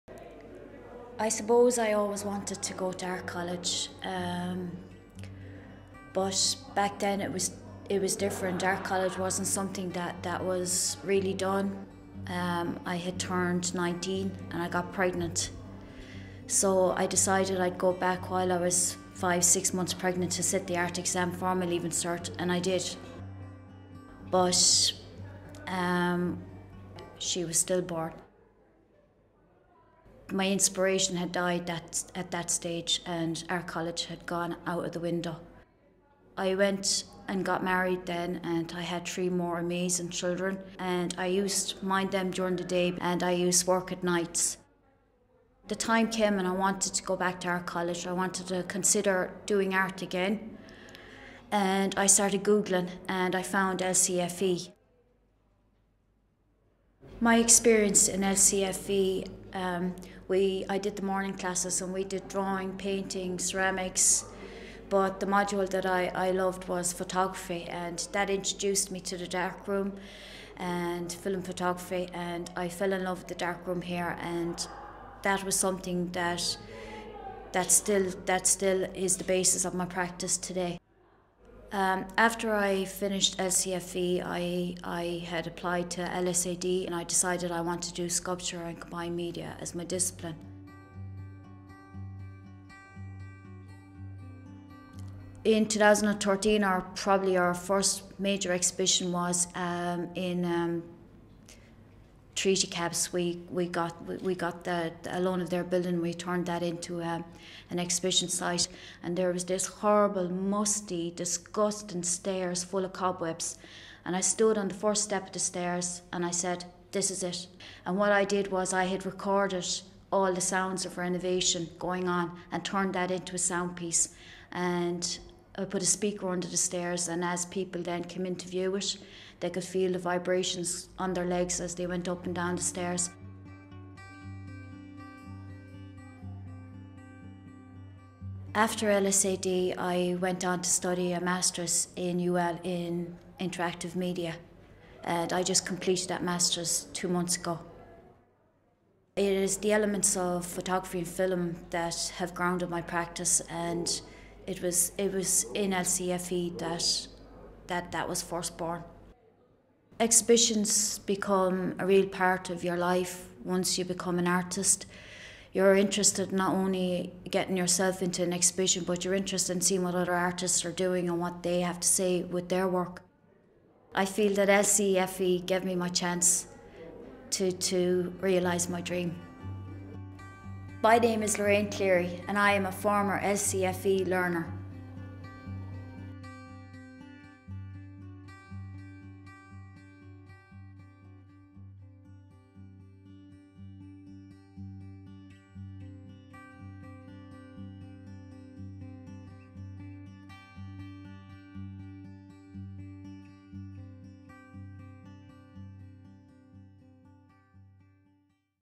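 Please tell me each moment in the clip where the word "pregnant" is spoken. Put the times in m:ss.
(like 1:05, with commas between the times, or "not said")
0:14, 0:19.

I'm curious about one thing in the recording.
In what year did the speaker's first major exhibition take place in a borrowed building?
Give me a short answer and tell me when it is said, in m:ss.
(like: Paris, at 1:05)
2013, at 1:35.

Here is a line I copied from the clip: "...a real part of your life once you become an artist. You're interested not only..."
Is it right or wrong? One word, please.
right.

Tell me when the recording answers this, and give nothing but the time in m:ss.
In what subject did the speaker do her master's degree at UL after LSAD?
2:23.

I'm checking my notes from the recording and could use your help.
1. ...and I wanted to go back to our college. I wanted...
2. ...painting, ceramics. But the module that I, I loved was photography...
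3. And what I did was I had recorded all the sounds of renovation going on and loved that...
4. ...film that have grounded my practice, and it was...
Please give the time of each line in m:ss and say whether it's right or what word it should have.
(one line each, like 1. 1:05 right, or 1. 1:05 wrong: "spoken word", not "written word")
1. 0:46 right
2. 1:02 right
3. 1:57 wrong: "turned", not "loved"
4. 2:31 right.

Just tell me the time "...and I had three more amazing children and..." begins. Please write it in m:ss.
0:38.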